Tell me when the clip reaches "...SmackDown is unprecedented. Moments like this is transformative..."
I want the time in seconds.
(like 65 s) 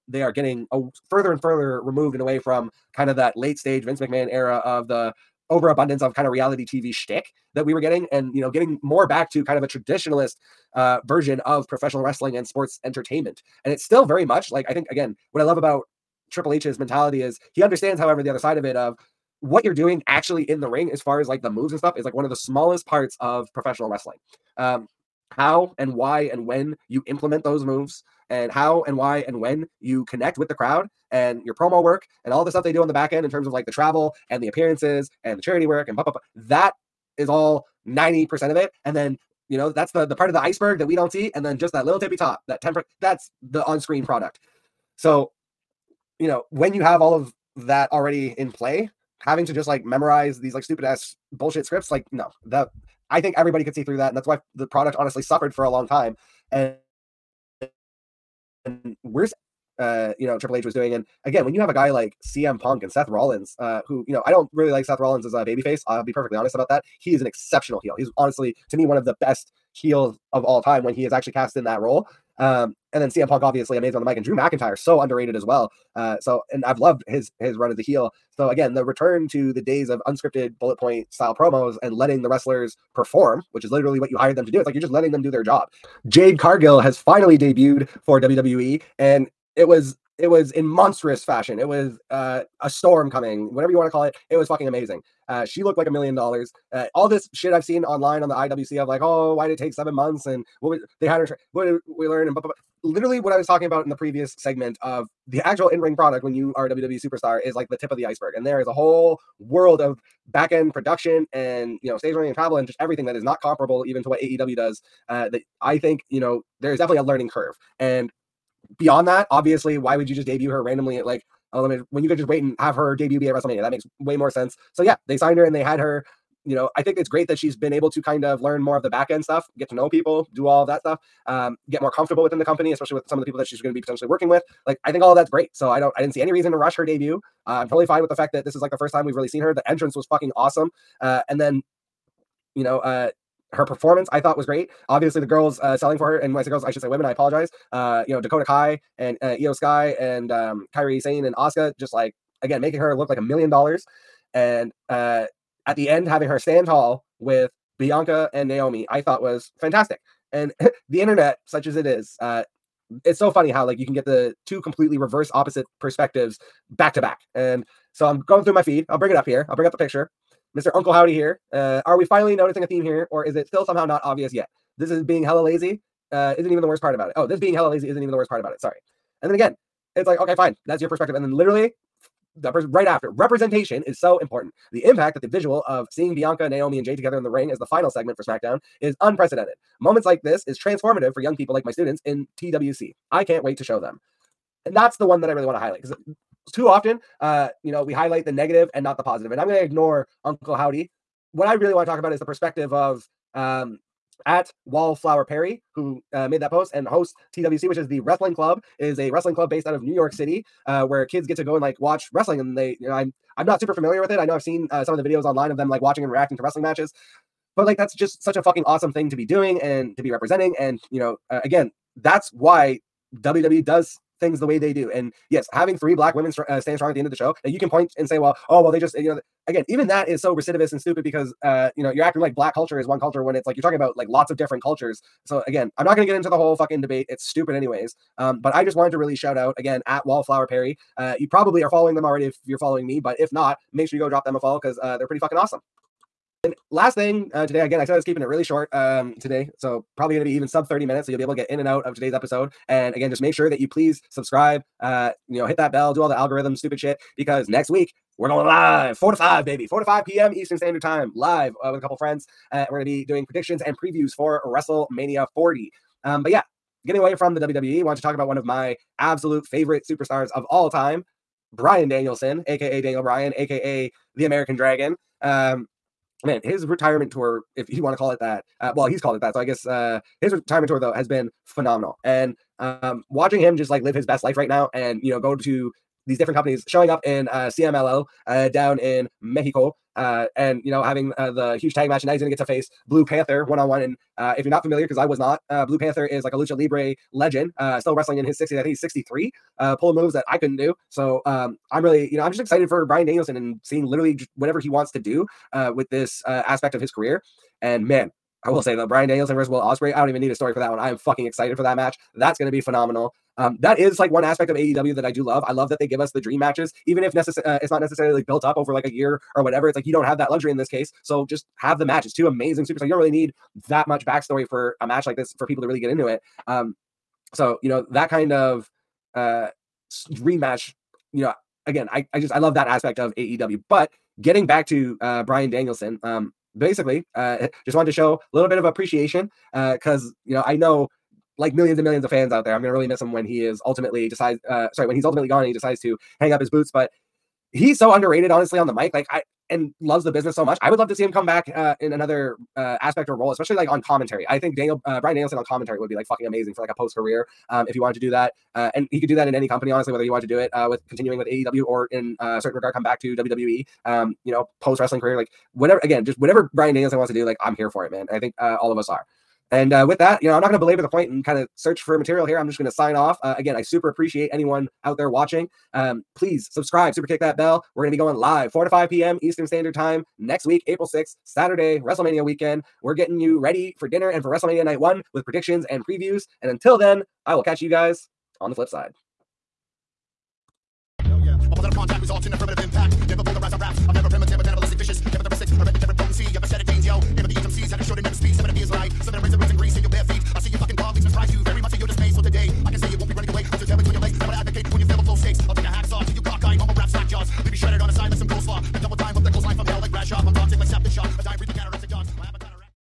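188 s.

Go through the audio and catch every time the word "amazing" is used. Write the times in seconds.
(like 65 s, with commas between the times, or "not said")
73 s, 94 s, 322 s, 356 s.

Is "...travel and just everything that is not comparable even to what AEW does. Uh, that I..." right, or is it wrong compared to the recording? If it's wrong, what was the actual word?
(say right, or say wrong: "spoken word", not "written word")
right.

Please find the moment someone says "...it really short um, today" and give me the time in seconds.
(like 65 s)
248 s.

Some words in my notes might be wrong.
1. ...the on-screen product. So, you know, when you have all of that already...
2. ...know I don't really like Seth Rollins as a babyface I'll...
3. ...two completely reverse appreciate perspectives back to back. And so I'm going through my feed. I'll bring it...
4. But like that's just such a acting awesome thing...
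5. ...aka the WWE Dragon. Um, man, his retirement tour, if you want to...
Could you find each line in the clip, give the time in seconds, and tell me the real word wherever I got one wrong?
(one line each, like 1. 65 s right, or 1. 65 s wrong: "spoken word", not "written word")
1. 43 s right
2. 64 s right
3. 164 s wrong: "opposite", not "appreciate"
4. 217 s wrong: "fucking", not "acting"
5. 273 s wrong: "American", not "WWE".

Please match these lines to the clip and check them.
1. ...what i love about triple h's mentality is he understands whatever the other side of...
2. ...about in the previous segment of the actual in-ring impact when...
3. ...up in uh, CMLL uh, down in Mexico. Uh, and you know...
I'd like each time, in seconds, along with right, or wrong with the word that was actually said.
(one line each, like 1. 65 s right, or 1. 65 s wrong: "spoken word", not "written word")
1. 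15 s wrong: "however", not "whatever"
2. 103 s wrong: "product", not "impact"
3. 286 s right.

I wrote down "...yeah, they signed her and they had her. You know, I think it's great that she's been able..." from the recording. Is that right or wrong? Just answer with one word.
right.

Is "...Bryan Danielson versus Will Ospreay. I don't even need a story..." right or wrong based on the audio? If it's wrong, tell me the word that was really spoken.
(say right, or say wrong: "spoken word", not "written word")
right.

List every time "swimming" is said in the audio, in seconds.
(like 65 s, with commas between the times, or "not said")
not said.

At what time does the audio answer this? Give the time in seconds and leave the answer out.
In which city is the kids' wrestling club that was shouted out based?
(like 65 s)
209 s.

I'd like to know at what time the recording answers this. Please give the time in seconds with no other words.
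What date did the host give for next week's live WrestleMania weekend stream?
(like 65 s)
380 s.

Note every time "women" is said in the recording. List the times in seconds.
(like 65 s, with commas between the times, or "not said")
146 s, 226 s.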